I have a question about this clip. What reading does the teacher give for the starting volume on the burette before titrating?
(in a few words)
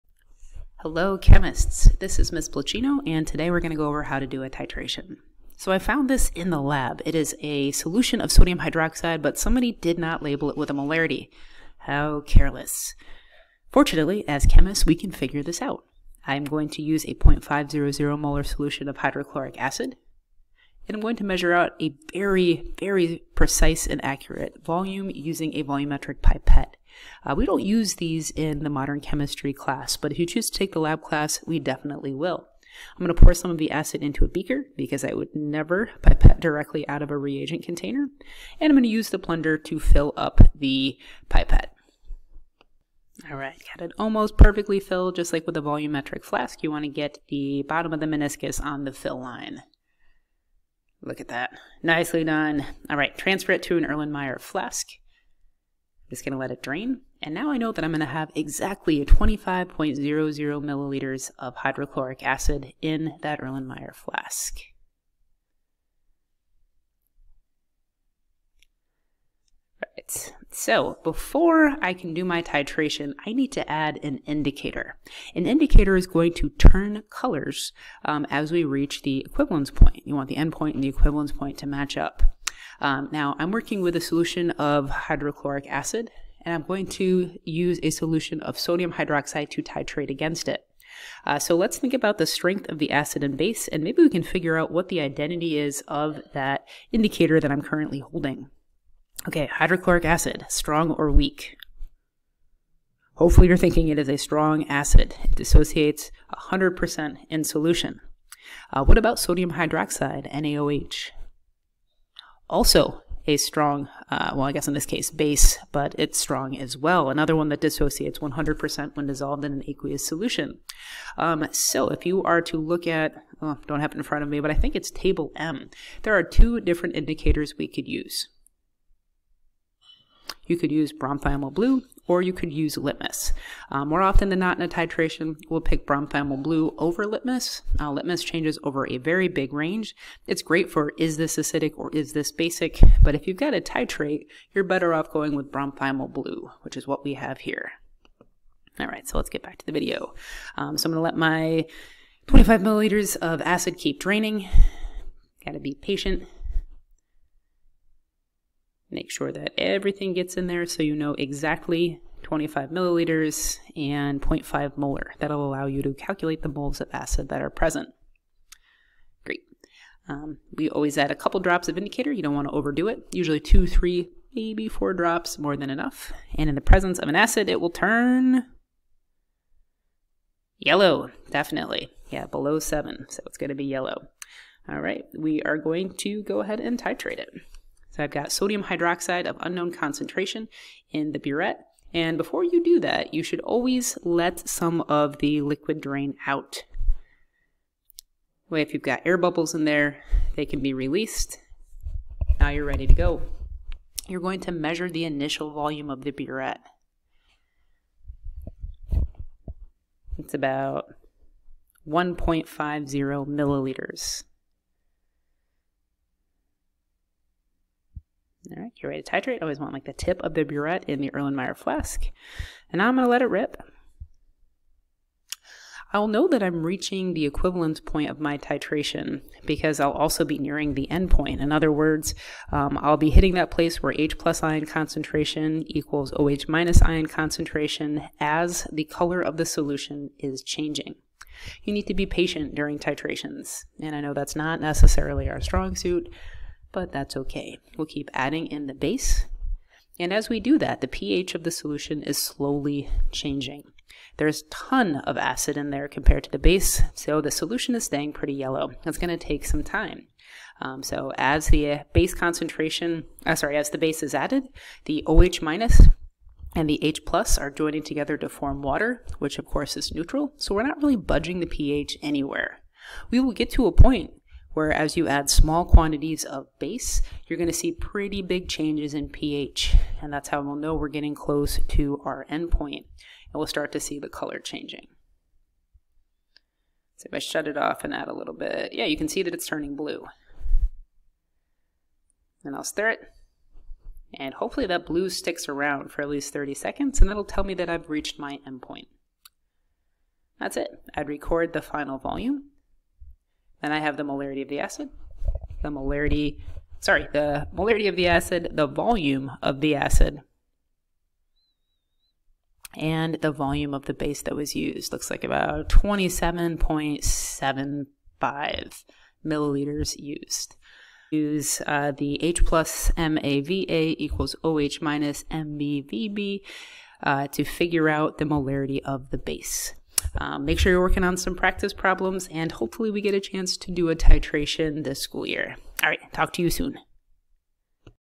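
1.50 milliliters.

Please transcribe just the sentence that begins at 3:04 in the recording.
All right, we are going to go ahead and titrate it.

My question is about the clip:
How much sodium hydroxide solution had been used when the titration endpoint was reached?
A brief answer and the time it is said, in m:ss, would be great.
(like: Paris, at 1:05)
27.75 milliliters, at 5:15.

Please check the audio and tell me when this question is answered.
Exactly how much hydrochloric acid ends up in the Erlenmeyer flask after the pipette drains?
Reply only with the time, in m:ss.
0:59.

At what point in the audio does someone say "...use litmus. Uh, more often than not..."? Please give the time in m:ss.
2:12.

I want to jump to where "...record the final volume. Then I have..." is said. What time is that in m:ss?
5:01.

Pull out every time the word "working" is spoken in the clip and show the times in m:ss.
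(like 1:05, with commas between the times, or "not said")
1:23, 5:30.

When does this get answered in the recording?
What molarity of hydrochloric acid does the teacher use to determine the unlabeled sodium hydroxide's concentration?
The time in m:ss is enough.
0:17.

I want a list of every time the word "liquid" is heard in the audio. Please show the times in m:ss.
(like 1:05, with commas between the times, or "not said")
3:15.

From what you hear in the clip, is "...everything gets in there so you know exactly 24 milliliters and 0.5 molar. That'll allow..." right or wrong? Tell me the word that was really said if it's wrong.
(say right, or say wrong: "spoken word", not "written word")
wrong: "25", not "24".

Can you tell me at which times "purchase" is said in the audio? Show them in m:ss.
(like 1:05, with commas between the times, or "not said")
not said.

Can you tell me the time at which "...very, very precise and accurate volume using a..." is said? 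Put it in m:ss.
0:22.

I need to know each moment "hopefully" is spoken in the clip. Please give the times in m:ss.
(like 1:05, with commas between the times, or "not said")
1:43, 4:54, 5:32.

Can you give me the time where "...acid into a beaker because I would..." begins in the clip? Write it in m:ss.
0:33.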